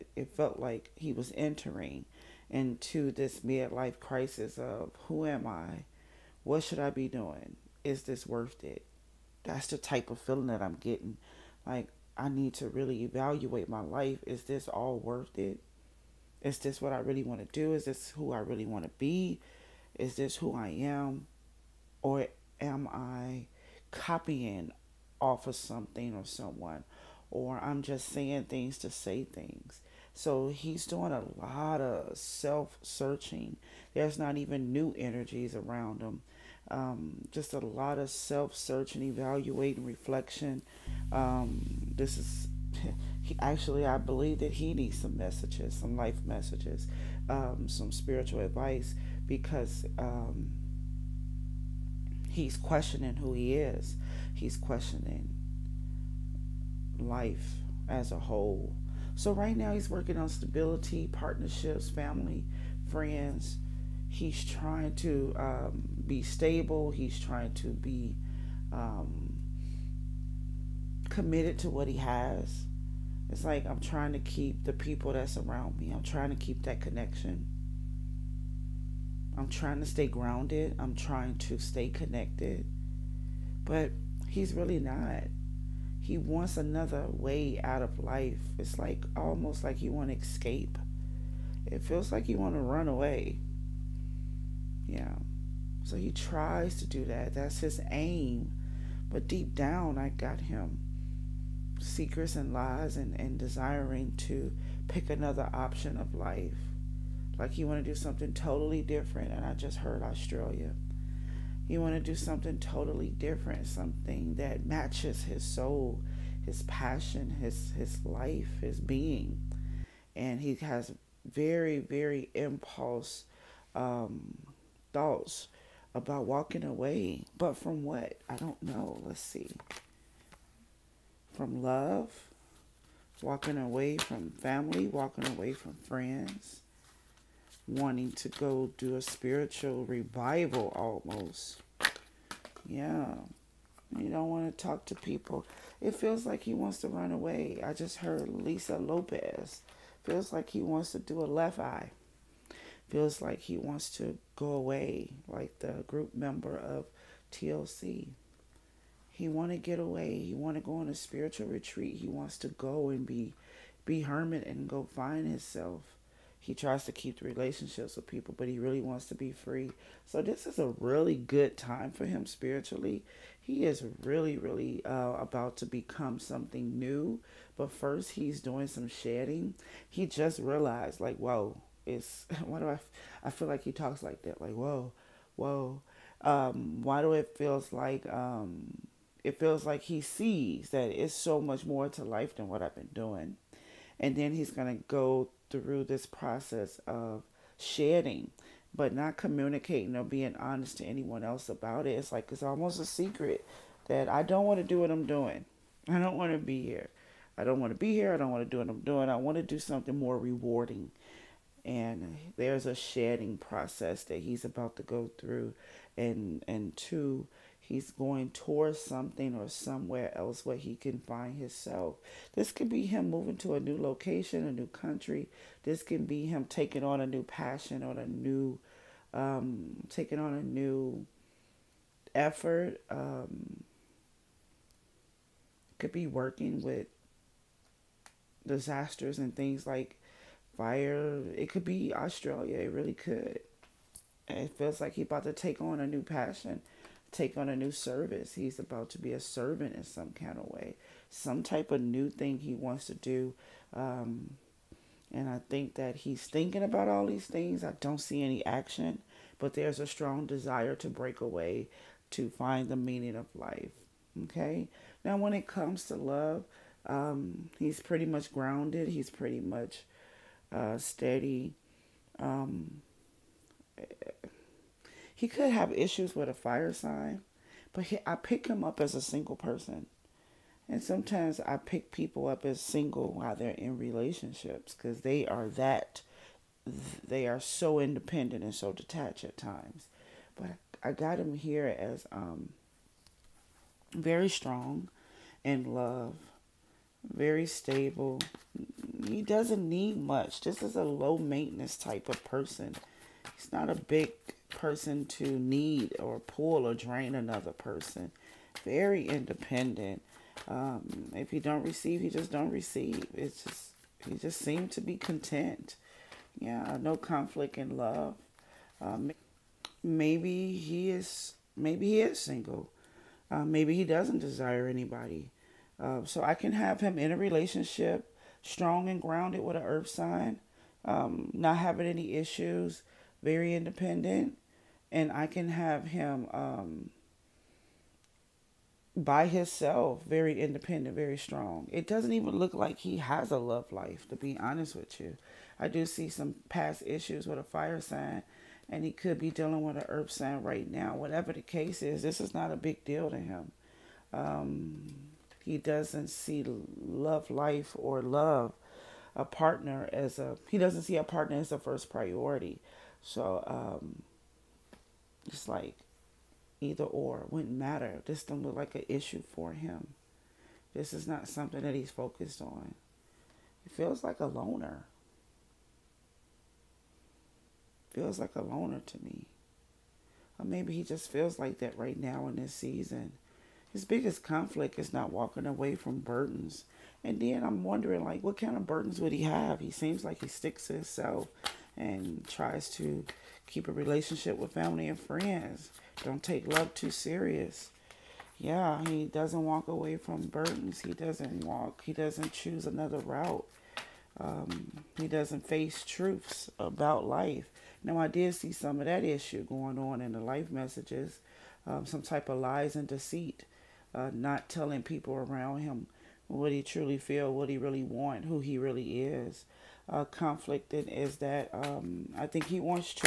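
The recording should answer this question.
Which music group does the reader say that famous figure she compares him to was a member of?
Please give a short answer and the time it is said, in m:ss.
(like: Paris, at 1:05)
TLC, at 2:37.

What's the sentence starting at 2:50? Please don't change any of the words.
So this is a really good time for him spiritually.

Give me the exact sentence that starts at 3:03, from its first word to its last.
I feel like he talks like that, like, whoa, whoa.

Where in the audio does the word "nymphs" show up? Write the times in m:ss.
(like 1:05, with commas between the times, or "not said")
not said.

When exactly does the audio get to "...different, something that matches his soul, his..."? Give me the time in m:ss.
1:53.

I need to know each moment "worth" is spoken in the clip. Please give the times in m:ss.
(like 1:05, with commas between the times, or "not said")
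0:08, 0:14.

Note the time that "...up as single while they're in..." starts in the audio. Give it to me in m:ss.
4:42.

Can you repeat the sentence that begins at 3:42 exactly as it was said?
This could be him moving to a new location, a new country.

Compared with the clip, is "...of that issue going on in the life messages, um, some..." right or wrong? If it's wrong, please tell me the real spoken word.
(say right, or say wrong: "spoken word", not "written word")
right.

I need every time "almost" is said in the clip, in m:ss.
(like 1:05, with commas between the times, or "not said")
1:29, 2:20, 3:22.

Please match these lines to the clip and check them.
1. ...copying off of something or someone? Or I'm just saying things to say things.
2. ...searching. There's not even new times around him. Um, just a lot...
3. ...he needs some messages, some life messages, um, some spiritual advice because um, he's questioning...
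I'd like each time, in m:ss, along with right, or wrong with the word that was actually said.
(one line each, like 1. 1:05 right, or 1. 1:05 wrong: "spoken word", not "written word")
1. 0:23 right
2. 0:32 wrong: "energies", not "times"
3. 0:44 right.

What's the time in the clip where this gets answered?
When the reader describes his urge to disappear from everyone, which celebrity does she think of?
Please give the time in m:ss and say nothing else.
2:28.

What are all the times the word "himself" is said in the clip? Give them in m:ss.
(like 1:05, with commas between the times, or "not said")
2:45, 3:41, 5:39, 6:30.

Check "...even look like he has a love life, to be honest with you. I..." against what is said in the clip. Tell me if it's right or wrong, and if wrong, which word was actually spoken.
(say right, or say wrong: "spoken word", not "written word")
right.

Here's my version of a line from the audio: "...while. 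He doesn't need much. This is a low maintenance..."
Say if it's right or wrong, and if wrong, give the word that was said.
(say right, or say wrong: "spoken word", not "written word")
wrong: "stable", not "while".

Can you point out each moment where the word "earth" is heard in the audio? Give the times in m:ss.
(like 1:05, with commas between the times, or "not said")
5:29, 5:49.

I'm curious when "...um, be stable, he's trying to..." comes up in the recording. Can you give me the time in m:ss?
1:05.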